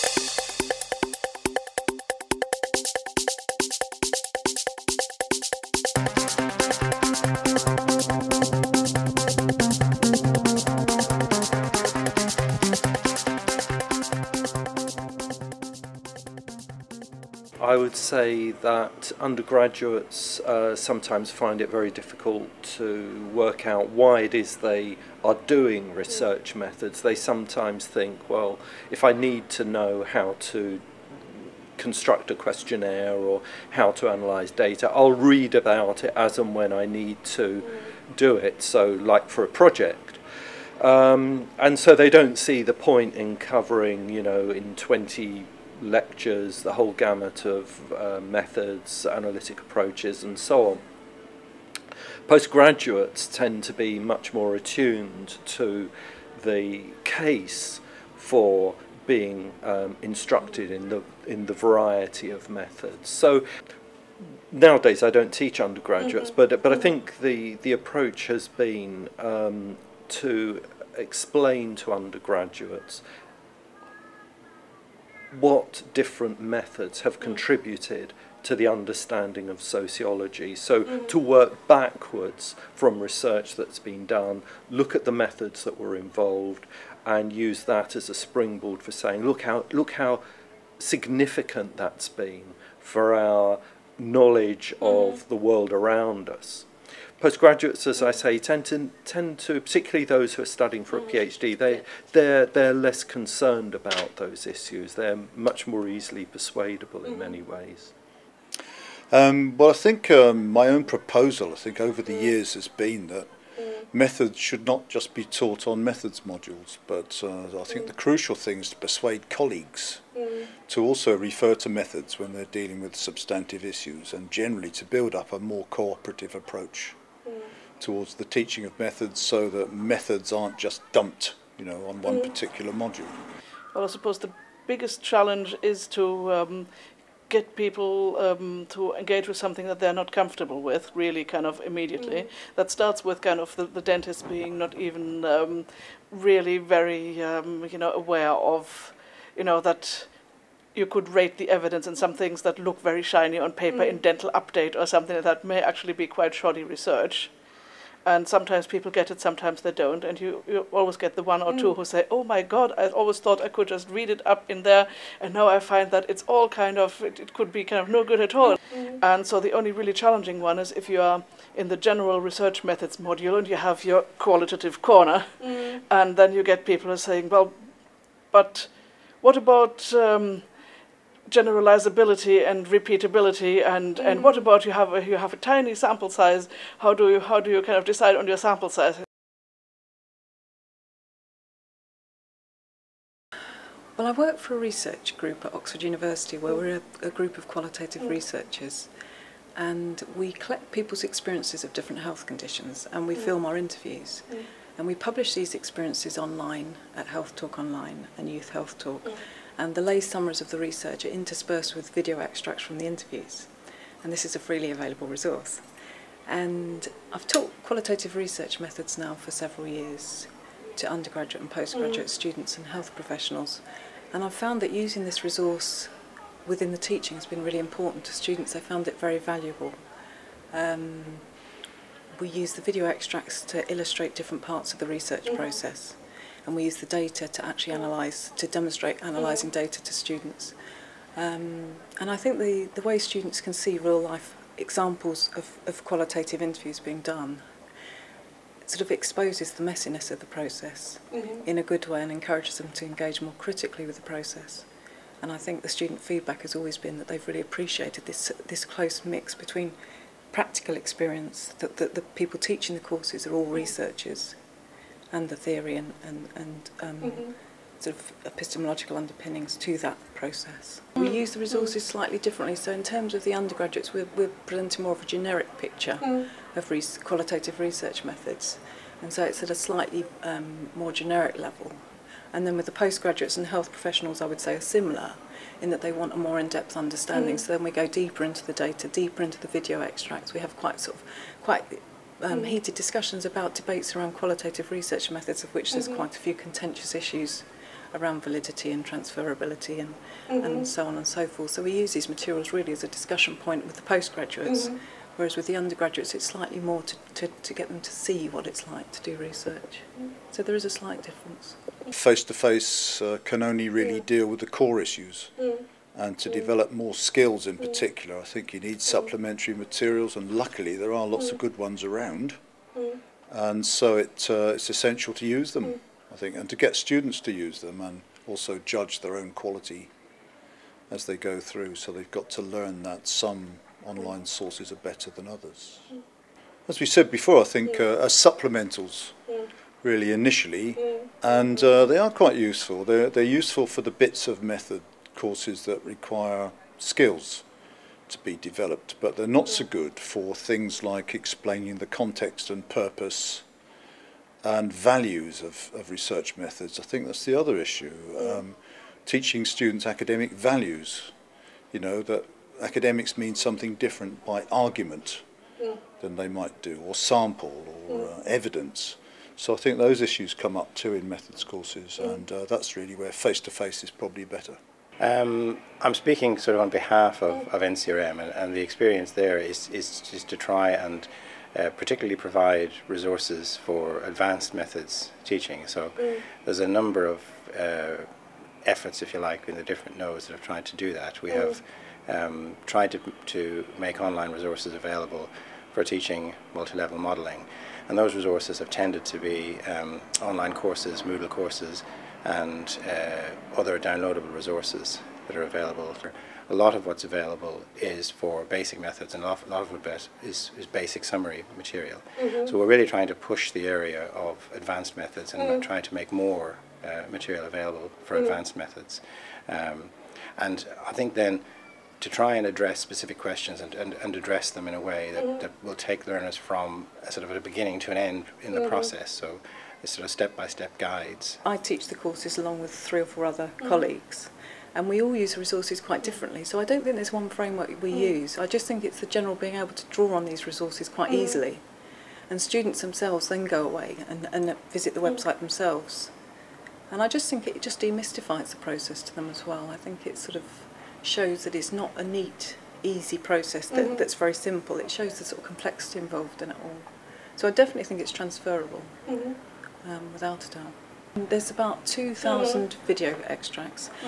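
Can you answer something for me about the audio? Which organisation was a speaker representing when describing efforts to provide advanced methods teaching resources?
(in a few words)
NCRM.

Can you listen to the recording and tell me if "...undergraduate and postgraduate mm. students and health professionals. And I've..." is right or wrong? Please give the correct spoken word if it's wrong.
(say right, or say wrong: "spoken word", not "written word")
right.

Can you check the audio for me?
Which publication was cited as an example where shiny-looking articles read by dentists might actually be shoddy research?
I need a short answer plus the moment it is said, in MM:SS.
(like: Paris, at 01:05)
Dental Update, at 02:34.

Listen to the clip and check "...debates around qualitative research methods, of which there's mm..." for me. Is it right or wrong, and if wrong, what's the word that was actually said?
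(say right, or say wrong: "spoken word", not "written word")
right.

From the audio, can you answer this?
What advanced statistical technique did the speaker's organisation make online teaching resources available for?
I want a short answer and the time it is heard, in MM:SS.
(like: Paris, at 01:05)
Multi-level modeling, at 06:36.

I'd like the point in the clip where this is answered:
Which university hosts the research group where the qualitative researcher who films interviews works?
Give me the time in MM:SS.
03:15.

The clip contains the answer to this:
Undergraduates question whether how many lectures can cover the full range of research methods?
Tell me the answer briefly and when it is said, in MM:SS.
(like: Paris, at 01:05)
20, at 00:44.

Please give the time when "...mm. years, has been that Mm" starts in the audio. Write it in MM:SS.
01:52.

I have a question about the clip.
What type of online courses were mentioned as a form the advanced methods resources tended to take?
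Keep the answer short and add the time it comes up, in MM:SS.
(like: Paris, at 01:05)
Moodle courses, at 06:41.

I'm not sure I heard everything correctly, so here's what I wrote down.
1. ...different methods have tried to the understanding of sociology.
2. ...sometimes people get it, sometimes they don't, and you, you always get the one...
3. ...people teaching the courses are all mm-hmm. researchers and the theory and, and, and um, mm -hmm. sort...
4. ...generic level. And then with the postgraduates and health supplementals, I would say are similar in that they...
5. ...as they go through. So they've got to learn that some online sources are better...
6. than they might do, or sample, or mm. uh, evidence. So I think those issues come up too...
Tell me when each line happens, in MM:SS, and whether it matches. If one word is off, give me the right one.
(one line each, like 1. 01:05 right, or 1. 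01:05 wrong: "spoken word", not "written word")
1. 01:15 wrong: "contributed", not "tried"
2. 02:38 right
3. 04:22 right
4. 04:40 wrong: "professionals", not "supplementals"
5. 05:30 right
6. 06:06 right.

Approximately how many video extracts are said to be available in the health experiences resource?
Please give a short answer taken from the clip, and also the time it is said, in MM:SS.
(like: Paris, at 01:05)
2,000, at 07:41.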